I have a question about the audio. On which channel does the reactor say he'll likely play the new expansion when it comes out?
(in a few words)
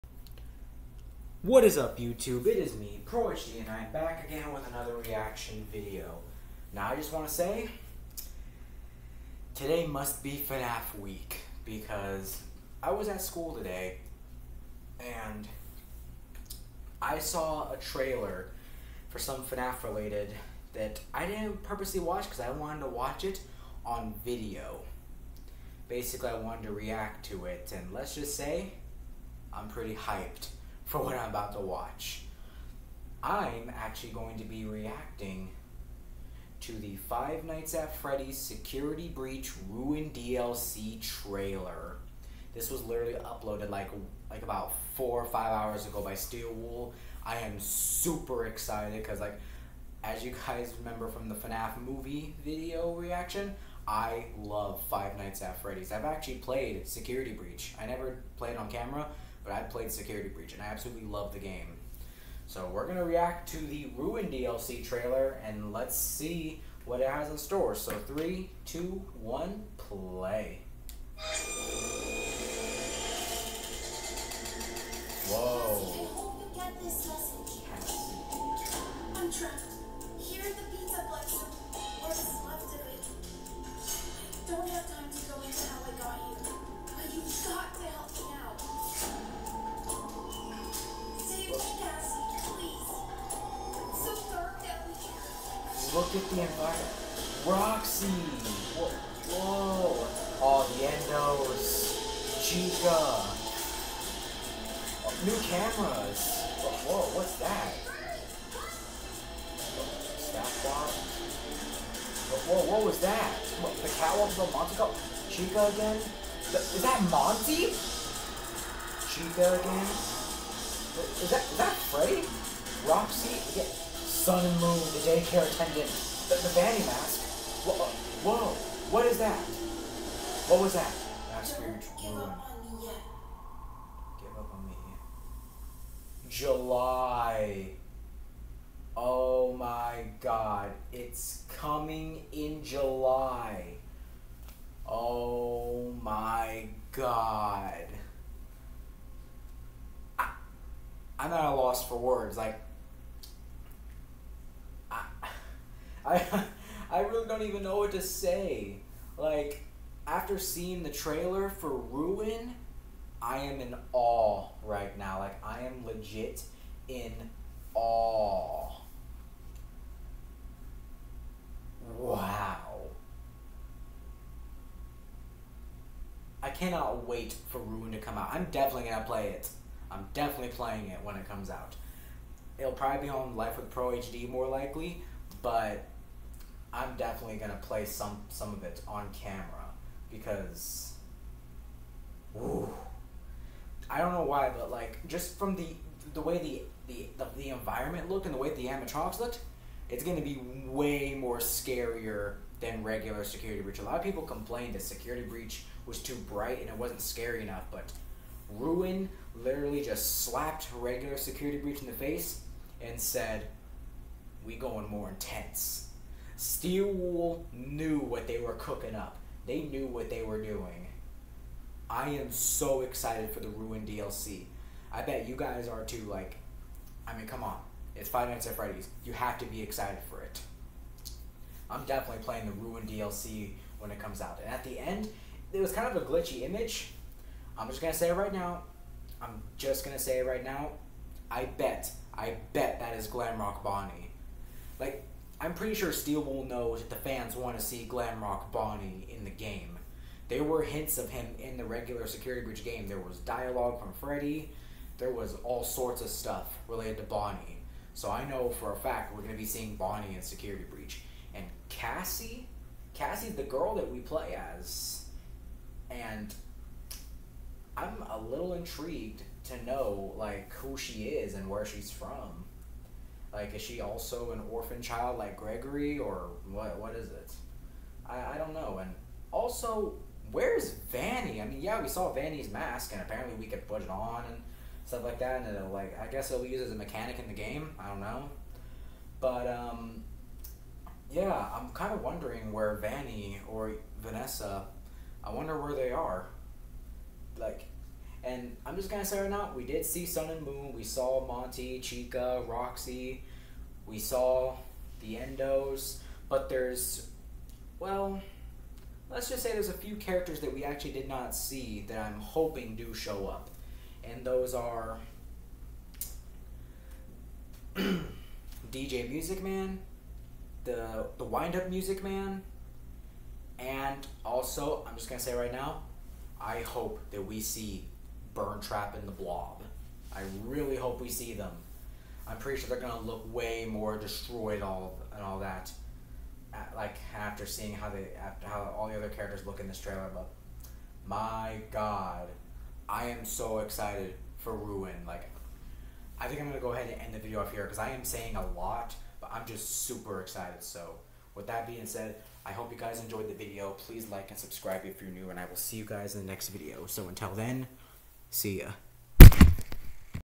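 Life with Pro HD.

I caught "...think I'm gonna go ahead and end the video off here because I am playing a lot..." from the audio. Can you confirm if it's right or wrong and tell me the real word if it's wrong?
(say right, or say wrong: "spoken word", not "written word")
wrong: "saying", not "playing".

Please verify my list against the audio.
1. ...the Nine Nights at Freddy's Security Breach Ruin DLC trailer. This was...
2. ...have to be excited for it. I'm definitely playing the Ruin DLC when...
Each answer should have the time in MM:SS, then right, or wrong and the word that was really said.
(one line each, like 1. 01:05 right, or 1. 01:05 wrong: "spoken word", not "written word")
1. 00:36 wrong: "Five", not "Nine"
2. 03:49 right.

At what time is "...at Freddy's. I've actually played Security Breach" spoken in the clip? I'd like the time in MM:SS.
00:55.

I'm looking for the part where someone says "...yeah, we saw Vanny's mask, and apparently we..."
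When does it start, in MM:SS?
04:41.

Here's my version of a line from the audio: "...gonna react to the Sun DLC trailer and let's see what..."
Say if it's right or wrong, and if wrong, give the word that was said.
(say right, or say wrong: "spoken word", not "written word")
wrong: "Ruin", not "Sun".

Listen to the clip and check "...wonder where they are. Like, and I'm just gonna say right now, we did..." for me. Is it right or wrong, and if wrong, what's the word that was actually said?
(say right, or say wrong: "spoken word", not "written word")
right.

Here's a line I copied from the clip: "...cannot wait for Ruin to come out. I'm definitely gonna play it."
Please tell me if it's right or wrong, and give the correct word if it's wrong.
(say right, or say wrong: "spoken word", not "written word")
right.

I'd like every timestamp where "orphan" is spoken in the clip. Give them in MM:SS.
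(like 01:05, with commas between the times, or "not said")
04:34.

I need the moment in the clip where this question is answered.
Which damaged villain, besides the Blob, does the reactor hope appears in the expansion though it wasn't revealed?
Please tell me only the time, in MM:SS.
05:28.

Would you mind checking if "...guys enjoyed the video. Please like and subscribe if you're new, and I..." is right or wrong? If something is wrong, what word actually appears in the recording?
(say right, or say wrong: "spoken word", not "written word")
right.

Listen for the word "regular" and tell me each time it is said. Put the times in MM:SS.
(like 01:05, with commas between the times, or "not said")
03:22, 03:30, 04:11.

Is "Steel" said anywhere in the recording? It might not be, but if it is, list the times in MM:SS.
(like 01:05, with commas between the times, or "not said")
00:46, 03:36, 04:05.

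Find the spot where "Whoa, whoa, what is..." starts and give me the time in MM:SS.
02:07.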